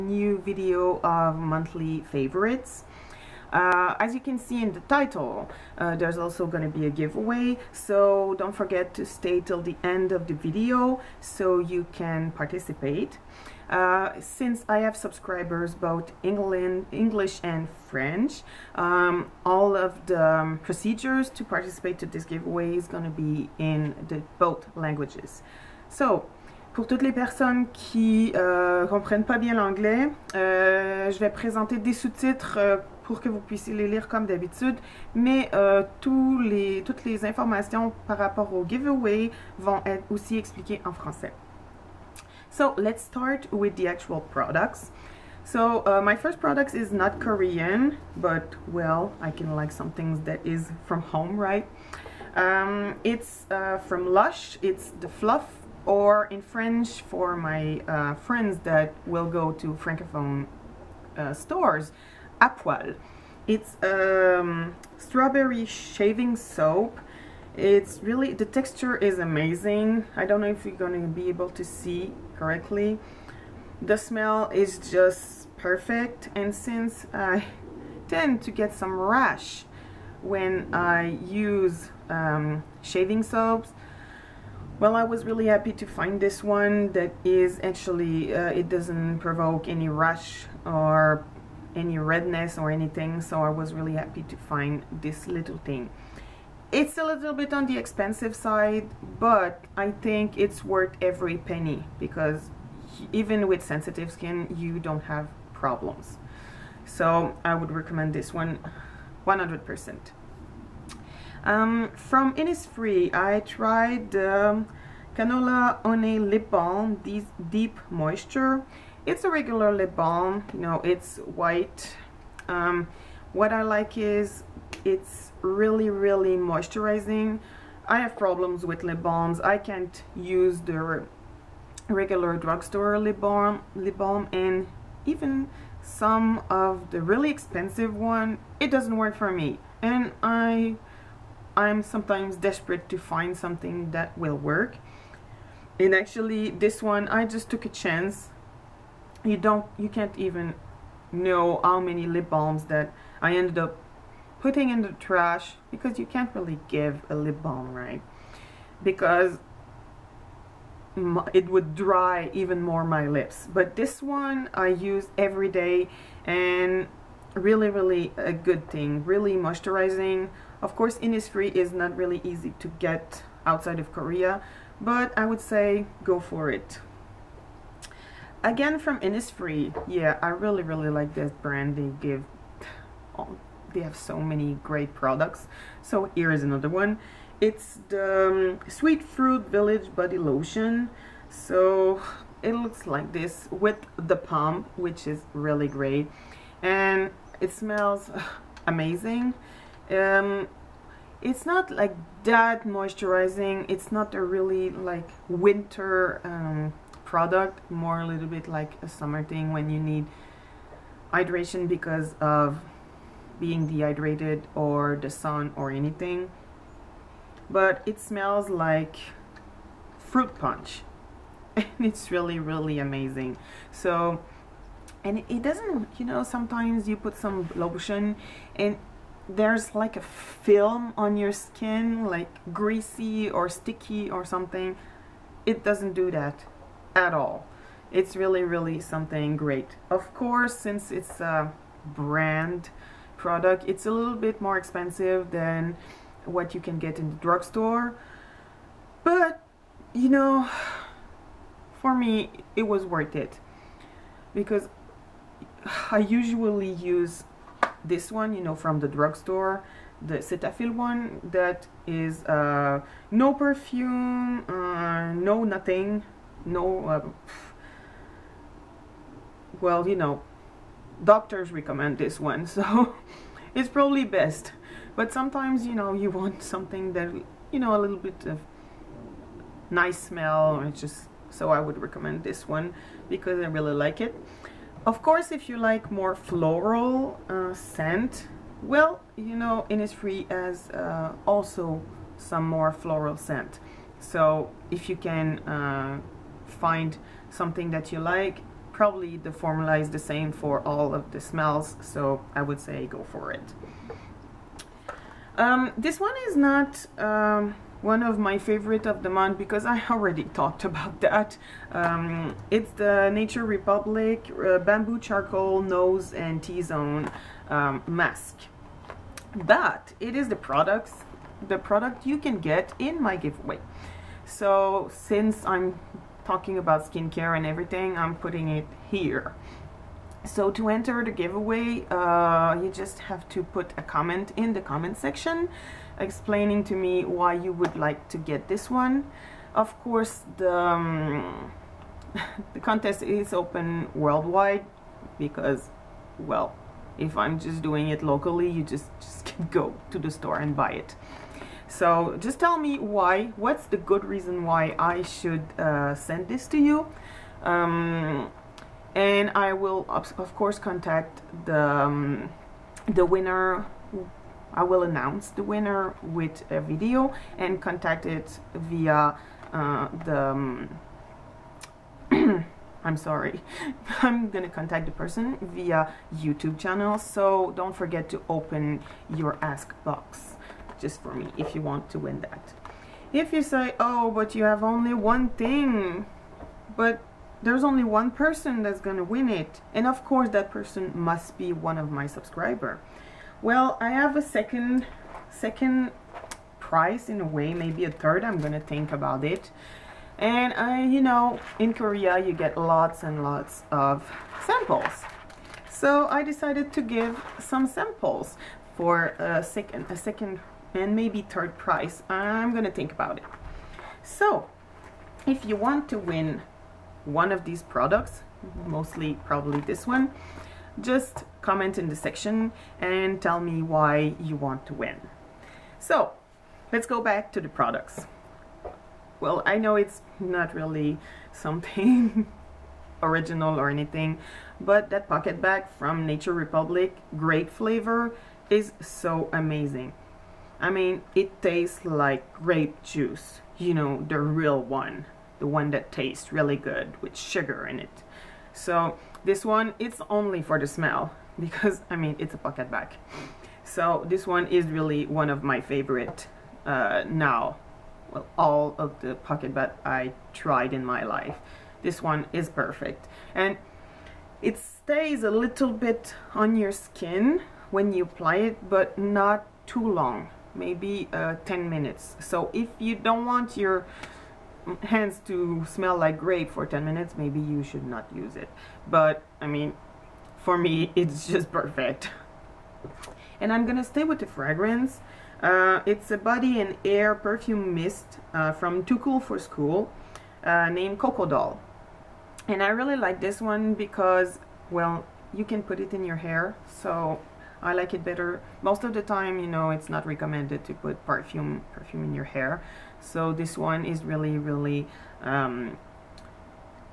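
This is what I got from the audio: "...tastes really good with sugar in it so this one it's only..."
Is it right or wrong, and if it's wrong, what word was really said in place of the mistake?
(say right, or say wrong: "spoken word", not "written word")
right.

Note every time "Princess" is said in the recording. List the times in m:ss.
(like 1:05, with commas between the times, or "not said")
not said.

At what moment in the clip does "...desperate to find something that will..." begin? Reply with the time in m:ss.
2:22.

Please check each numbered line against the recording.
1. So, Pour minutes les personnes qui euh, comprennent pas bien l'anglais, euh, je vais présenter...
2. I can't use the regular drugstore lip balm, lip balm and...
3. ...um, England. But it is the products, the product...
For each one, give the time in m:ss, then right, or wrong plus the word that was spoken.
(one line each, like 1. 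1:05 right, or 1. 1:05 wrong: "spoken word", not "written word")
1. 0:25 wrong: "toutes", not "minutes"
2. 2:09 right
3. 5:17 wrong: "Mask", not "England".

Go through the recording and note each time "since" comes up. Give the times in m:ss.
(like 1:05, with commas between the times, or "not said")
0:14, 1:16, 4:00, 5:24.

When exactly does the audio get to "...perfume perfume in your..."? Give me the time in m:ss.
8:21.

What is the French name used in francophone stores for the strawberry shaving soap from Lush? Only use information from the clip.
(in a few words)
à poil.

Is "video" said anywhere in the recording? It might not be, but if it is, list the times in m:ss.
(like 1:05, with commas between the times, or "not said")
0:00, 0:10, 6:06.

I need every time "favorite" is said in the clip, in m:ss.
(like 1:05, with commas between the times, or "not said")
0:02, 5:08, 7:35.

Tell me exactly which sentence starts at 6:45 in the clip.
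So I decided to give some samples for a second, a second and maybe third prize.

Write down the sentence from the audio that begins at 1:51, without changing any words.
Um, from Innisfree, I tried um, Canola Honey Lip Balm, this Deep Moisture.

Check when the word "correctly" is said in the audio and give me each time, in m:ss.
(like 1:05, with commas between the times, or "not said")
1:12.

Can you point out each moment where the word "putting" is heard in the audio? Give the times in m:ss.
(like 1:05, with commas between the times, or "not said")
2:34, 5:28.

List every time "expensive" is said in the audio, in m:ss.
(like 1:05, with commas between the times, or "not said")
1:37, 2:17, 4:04.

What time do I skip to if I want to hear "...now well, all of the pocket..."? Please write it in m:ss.
7:37.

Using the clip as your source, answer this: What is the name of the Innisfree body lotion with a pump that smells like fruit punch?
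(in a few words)
Sweet Fruit Village.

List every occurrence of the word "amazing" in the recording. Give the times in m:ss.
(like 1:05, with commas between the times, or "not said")
1:09, 3:18, 3:42, 7:19.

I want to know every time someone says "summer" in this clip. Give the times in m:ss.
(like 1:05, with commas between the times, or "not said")
3:28.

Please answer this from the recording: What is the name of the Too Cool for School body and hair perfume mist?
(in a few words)
Coco Doll.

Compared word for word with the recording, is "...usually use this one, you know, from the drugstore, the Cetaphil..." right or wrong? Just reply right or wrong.
right.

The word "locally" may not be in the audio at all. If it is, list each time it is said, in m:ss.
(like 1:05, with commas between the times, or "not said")
5:48.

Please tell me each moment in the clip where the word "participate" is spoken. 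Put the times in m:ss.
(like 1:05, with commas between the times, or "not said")
0:12, 0:21.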